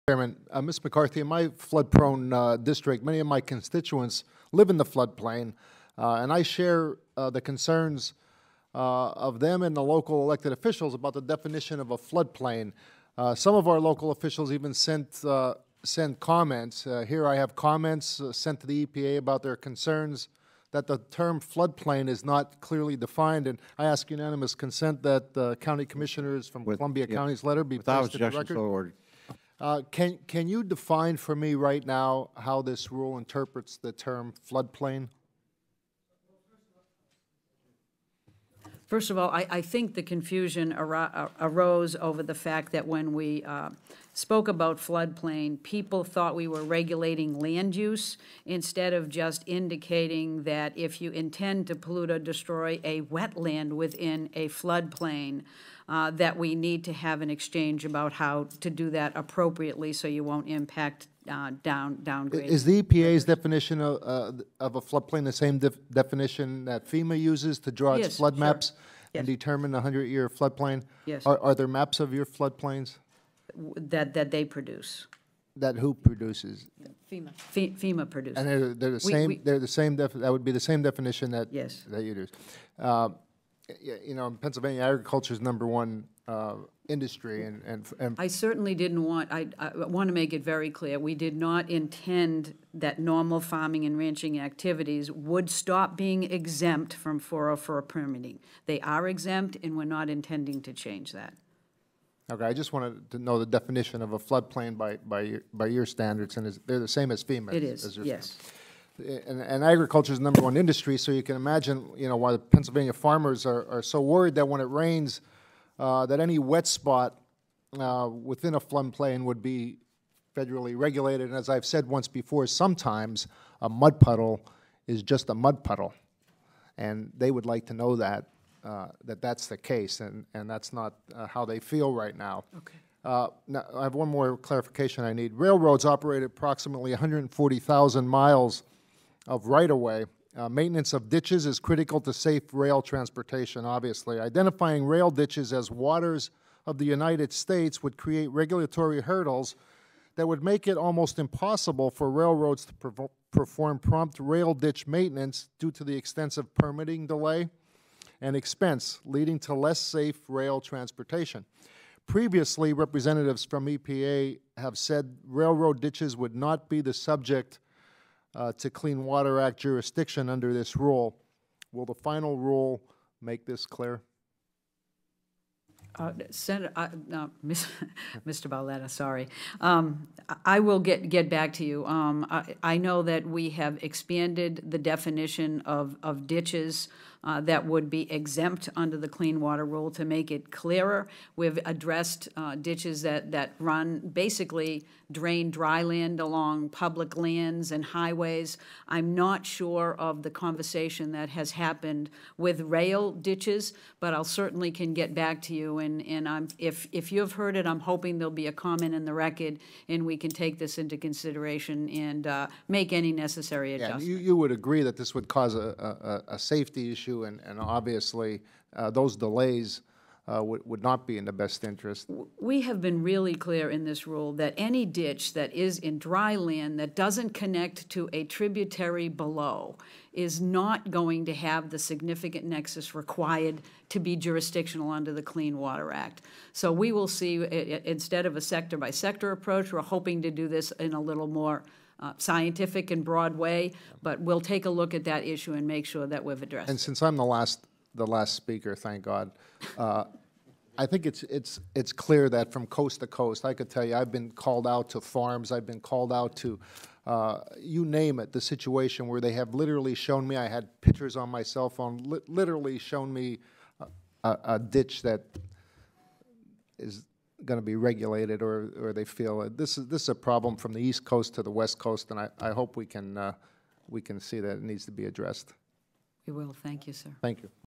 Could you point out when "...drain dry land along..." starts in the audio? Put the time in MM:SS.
03:15.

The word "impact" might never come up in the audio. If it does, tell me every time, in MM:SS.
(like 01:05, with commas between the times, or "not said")
01:00.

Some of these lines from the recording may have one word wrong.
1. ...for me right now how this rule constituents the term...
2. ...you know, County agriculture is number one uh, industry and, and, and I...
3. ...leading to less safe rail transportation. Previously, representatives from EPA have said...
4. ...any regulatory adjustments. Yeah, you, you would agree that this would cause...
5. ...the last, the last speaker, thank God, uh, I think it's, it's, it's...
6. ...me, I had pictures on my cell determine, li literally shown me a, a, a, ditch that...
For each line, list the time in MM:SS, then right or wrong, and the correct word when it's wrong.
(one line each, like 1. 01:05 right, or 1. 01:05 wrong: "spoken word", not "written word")
1. 00:31 wrong: "interprets", not "constituents"
2. 01:23 wrong: "Pennsylvania", not "County"
3. 02:39 right
4. 03:32 wrong: "necessary", not "regulatory"
5. 04:07 right
6. 04:20 wrong: "phone", not "determine".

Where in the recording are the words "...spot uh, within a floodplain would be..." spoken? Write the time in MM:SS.
01:56.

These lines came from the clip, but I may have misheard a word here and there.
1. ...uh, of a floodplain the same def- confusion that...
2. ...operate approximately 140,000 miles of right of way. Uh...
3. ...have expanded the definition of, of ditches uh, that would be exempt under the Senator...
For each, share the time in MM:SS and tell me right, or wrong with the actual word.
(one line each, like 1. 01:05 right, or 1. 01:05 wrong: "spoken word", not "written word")
1. 01:04 wrong: "definition", not "confusion"
2. 02:15 right
3. 03:03 wrong: "Clean", not "Senator".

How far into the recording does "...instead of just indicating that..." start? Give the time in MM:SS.
00:48.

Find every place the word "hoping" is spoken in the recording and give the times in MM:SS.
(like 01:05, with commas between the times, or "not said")
03:27, 03:59.